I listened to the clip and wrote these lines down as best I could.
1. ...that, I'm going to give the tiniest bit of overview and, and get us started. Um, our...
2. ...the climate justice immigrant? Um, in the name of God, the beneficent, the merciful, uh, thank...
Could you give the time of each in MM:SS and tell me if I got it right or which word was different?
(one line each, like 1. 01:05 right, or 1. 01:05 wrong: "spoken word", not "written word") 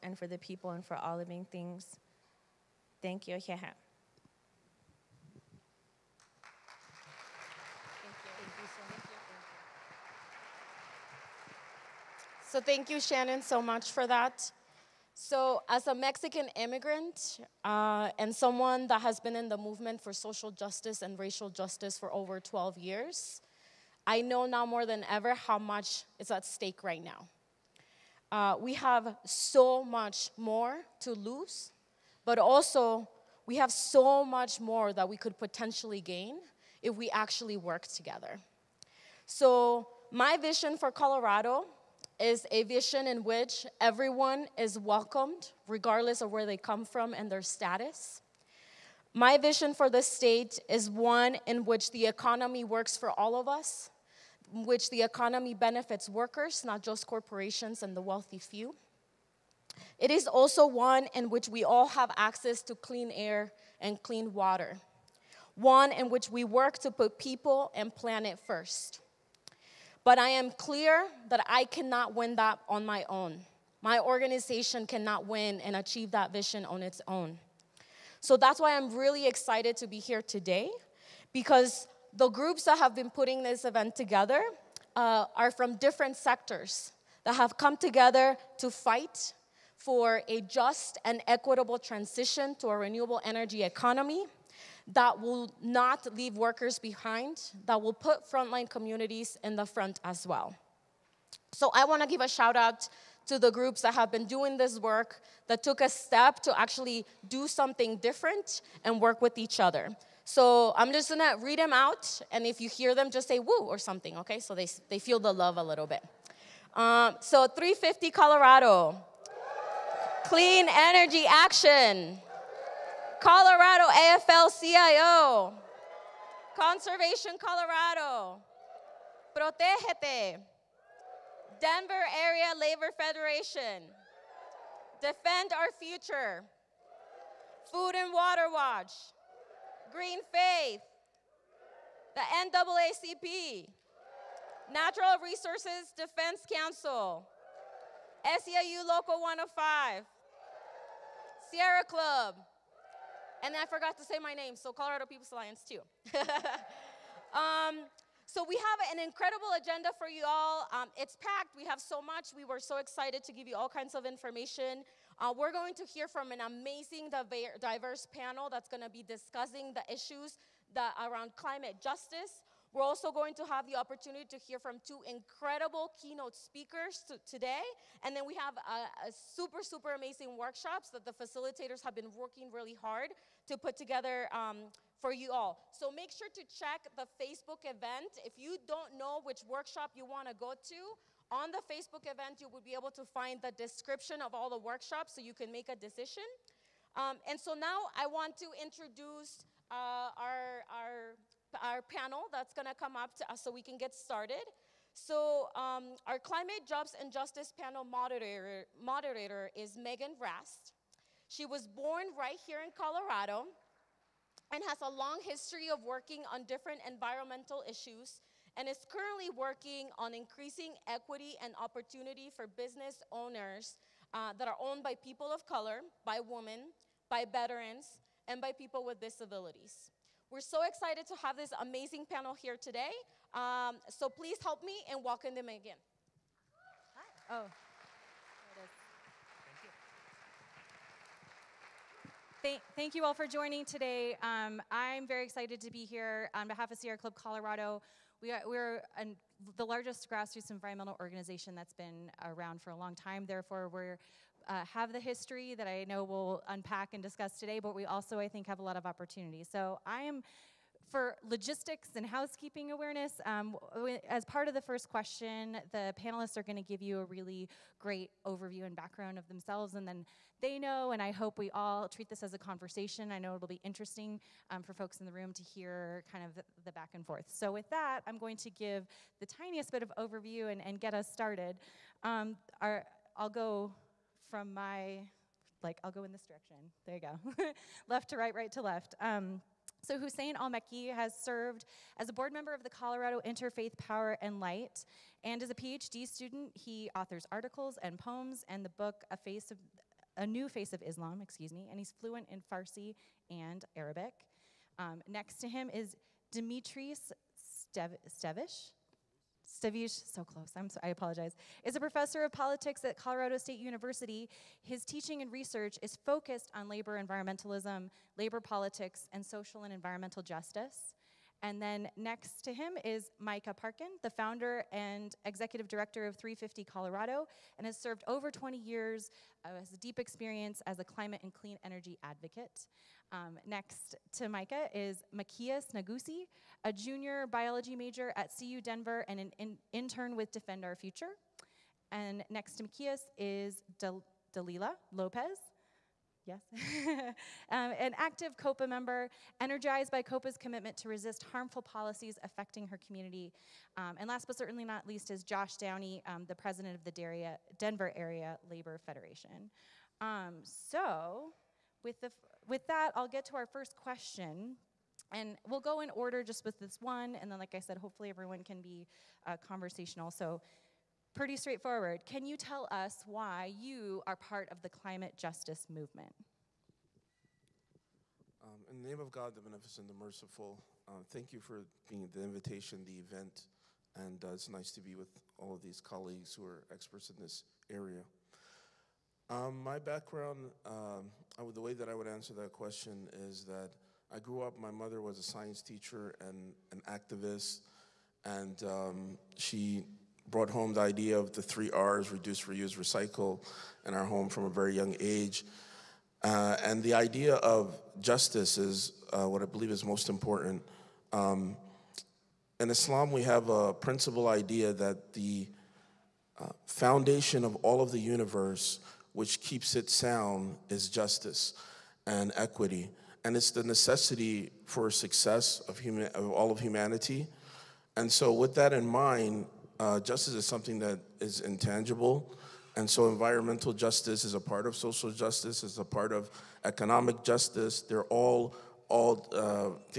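1. 04:37 right
2. 06:14 wrong: "movement", not "immigrant".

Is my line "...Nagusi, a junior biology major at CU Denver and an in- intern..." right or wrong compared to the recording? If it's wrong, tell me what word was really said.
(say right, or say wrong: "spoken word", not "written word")
right.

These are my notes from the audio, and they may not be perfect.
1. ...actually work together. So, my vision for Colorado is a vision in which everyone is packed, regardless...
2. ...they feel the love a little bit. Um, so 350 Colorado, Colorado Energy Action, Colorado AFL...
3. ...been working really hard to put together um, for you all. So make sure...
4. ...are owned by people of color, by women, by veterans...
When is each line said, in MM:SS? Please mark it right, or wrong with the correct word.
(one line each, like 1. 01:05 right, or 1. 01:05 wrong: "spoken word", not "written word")
1. 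00:37 wrong: "welcomed", not "packed"
2. 01:54 wrong: "Clean", not "Colorado"
3. 03:01 right
4. 03:44 right.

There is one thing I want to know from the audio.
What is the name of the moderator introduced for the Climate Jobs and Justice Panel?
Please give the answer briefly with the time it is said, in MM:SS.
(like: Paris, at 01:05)
Megan Rast, at 03:29.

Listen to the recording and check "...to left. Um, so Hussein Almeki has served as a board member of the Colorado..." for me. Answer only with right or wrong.
right.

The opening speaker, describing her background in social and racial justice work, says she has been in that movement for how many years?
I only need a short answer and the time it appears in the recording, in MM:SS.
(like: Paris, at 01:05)
12, at 00:22.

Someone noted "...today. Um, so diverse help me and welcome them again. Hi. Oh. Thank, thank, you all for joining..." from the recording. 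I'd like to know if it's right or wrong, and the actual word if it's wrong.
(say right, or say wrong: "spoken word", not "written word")
wrong: "please", not "diverse".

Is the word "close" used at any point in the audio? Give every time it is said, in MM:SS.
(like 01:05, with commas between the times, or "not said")
05:10.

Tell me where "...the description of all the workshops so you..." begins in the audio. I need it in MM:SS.
03:13.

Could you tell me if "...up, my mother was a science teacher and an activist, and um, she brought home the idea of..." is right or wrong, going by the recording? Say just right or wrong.
right.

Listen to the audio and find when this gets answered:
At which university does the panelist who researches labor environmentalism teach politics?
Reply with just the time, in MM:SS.
05:12.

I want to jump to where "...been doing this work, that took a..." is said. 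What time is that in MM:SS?
01:44.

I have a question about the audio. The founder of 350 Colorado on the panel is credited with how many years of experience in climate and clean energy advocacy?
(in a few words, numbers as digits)
20.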